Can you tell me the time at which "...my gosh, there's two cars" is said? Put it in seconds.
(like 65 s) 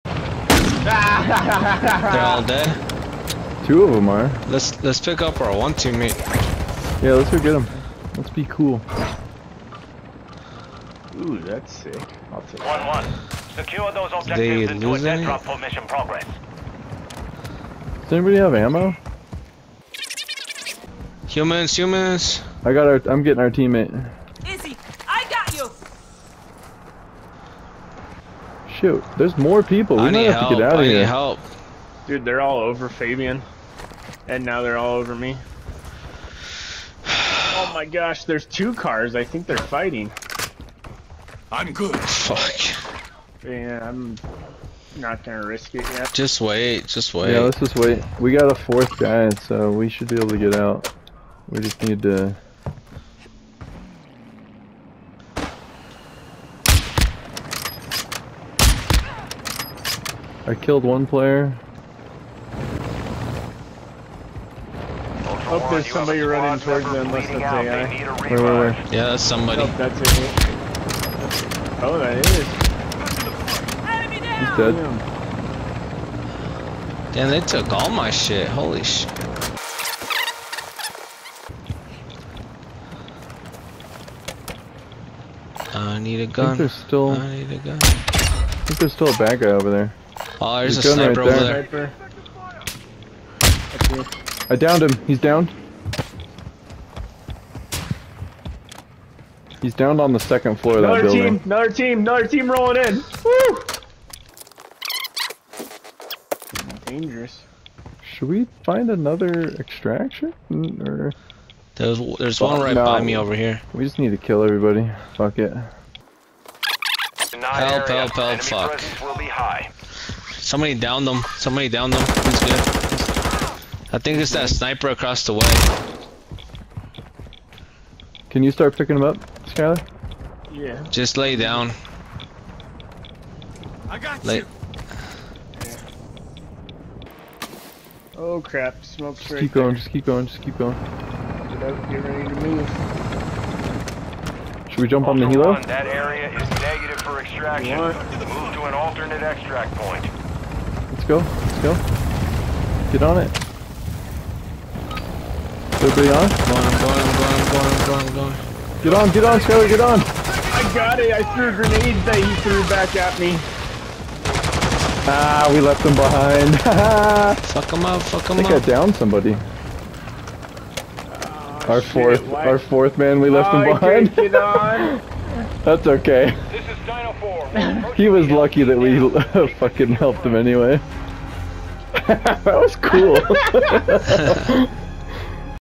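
37 s.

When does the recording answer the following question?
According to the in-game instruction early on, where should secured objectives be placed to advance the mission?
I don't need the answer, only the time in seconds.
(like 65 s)
14 s.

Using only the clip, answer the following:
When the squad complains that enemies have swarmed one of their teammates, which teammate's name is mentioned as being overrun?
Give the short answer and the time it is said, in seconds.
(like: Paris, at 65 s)
Fabian, at 32 s.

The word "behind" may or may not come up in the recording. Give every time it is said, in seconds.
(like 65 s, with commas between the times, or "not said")
165 s, 174 s.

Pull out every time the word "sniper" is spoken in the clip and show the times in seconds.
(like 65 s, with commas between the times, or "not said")
90 s, 124 s.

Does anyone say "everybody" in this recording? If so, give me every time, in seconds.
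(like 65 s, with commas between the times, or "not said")
114 s, 155 s.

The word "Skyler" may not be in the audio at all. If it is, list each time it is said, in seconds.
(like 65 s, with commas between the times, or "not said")
129 s, 159 s.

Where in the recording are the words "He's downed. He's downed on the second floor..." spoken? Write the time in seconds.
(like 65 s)
95 s.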